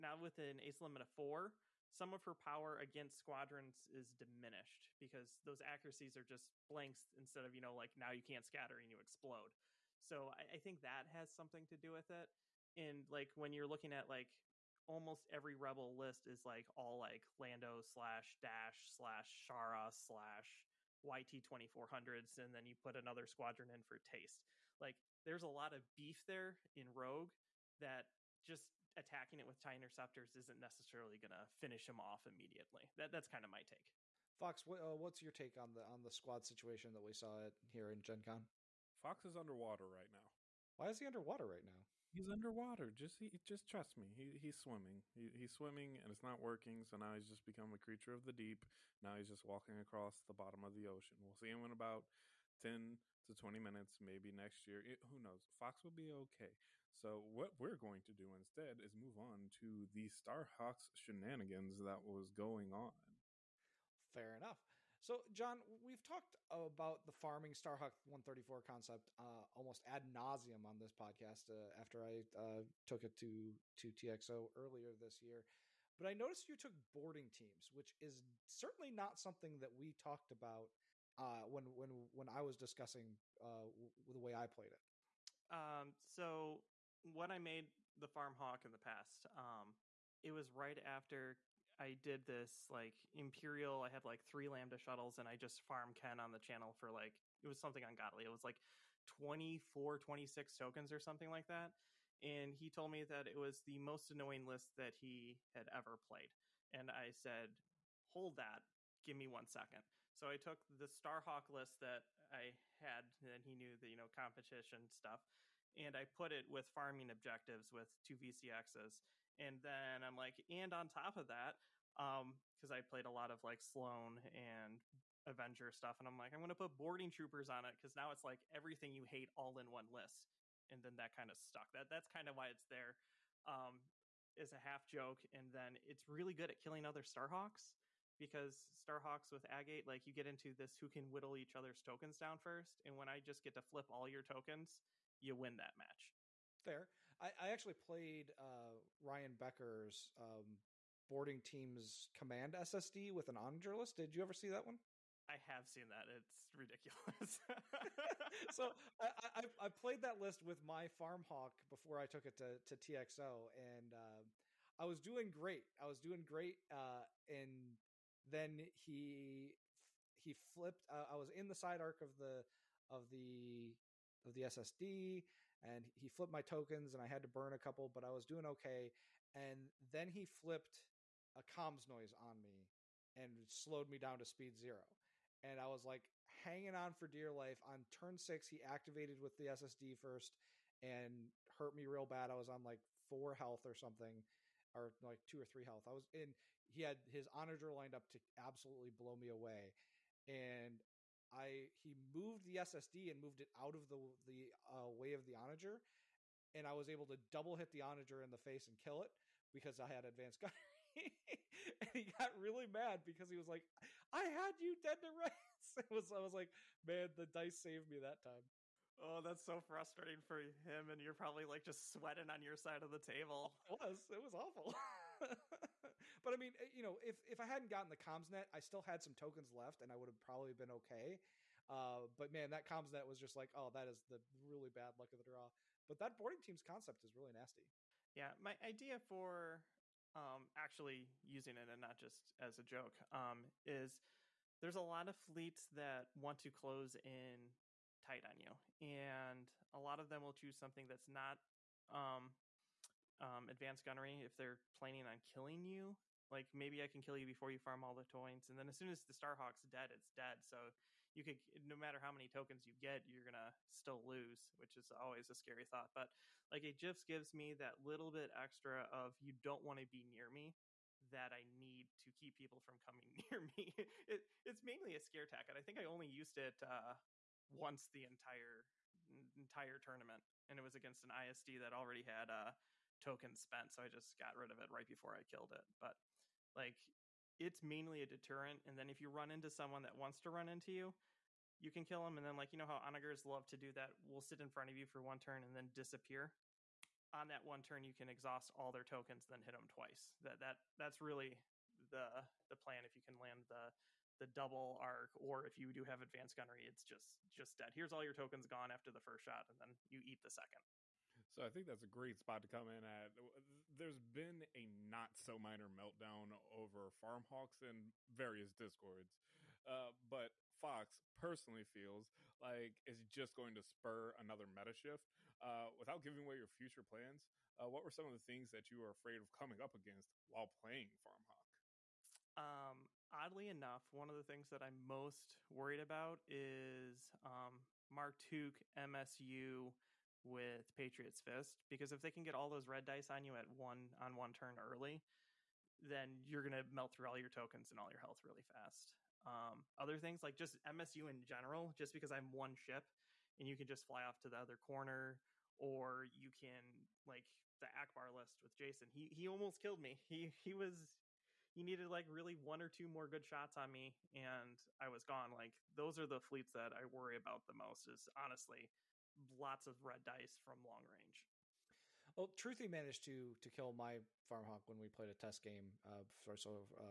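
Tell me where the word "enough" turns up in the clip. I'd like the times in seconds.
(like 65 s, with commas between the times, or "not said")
64 s, 333 s.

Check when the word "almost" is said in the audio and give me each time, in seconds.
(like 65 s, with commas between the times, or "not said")
14 s, 69 s, 359 s.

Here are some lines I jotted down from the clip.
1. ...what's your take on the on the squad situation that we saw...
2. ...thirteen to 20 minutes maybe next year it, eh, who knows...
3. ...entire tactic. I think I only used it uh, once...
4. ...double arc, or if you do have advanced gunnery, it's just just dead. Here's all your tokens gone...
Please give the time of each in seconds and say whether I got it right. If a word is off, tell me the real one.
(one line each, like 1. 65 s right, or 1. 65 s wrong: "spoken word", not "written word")
1. 34 s right
2. 52 s wrong: "ten", not "thirteen"
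3. 275 s wrong: "scare", not "entire"
4. 304 s right.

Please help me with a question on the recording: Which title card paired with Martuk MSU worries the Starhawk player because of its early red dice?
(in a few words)
Patriots Fist.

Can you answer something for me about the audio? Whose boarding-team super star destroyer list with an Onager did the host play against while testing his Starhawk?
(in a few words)
Ryan Becker.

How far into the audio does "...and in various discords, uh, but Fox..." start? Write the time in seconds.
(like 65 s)
317 s.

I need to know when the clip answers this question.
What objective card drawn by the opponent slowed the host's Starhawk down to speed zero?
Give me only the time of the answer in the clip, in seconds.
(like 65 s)
181 s.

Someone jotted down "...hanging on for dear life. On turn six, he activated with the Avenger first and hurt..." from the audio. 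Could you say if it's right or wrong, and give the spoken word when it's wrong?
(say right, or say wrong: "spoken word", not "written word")
wrong: "SSD", not "Avenger".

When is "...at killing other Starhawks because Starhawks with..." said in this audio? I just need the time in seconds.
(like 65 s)
136 s.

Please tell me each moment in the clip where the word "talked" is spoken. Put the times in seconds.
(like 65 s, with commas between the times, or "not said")
66 s, 79 s.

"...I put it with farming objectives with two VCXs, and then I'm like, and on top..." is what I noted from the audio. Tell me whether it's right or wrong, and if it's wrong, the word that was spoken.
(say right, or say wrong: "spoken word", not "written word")
right.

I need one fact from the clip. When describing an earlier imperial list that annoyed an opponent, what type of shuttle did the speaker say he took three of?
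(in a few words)
Lambda shuttles.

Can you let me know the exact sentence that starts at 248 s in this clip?
And a lot of them will choose something that's not um, um, advanced gunnery if they're planning on killing you.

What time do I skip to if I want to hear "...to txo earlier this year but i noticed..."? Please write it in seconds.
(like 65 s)
73 s.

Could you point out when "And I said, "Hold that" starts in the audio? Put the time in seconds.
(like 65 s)
106 s.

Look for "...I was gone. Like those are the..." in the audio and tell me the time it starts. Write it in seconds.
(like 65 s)
364 s.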